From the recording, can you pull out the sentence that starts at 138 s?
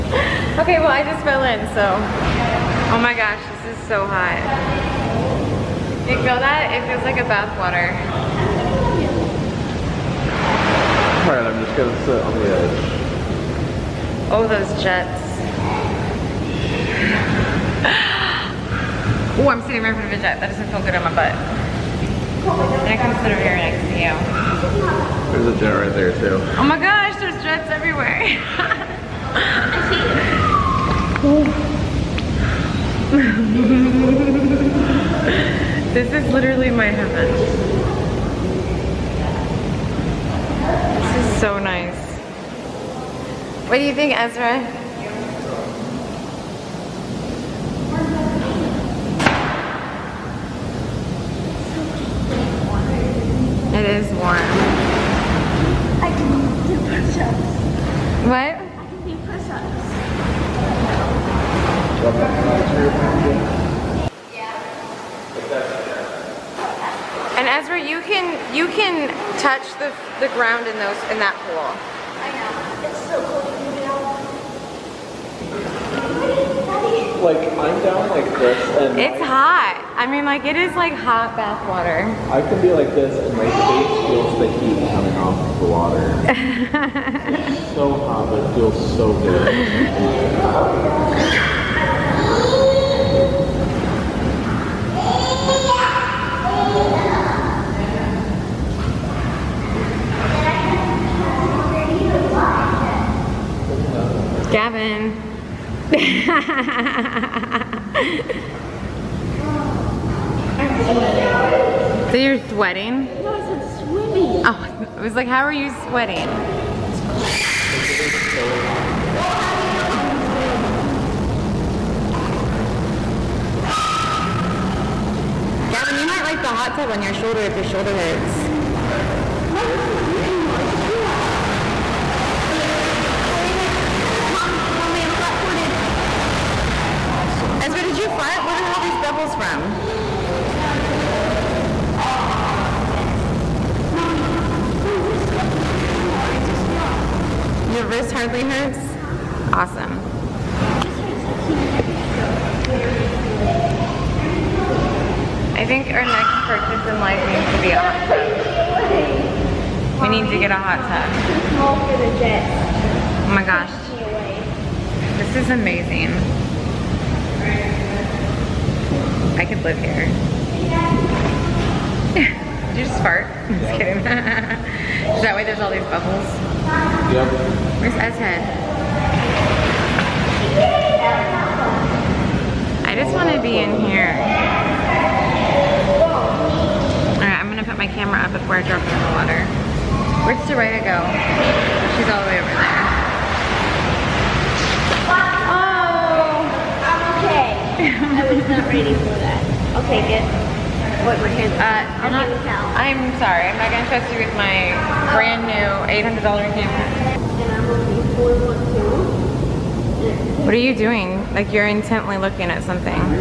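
What are all these bubbles from?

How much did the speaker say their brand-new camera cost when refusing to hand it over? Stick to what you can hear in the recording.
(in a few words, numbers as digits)
$800.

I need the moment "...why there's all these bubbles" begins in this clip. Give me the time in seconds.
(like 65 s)
175 s.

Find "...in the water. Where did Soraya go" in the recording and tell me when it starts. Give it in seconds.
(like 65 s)
188 s.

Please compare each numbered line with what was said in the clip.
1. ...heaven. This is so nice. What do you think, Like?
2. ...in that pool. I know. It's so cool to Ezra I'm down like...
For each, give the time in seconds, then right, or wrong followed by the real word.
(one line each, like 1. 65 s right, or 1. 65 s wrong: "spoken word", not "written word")
1. 36 s wrong: "Ezra", not "Like"
2. 71 s wrong: "Like", not "Ezra".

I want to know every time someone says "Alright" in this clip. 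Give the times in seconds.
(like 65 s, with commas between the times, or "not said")
11 s, 187 s.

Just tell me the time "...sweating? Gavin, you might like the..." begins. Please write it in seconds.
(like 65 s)
125 s.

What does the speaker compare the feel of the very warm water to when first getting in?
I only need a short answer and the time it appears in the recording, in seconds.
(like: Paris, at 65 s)
Bathwater, at 7 s.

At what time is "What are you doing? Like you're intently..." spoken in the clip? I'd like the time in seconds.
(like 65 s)
210 s.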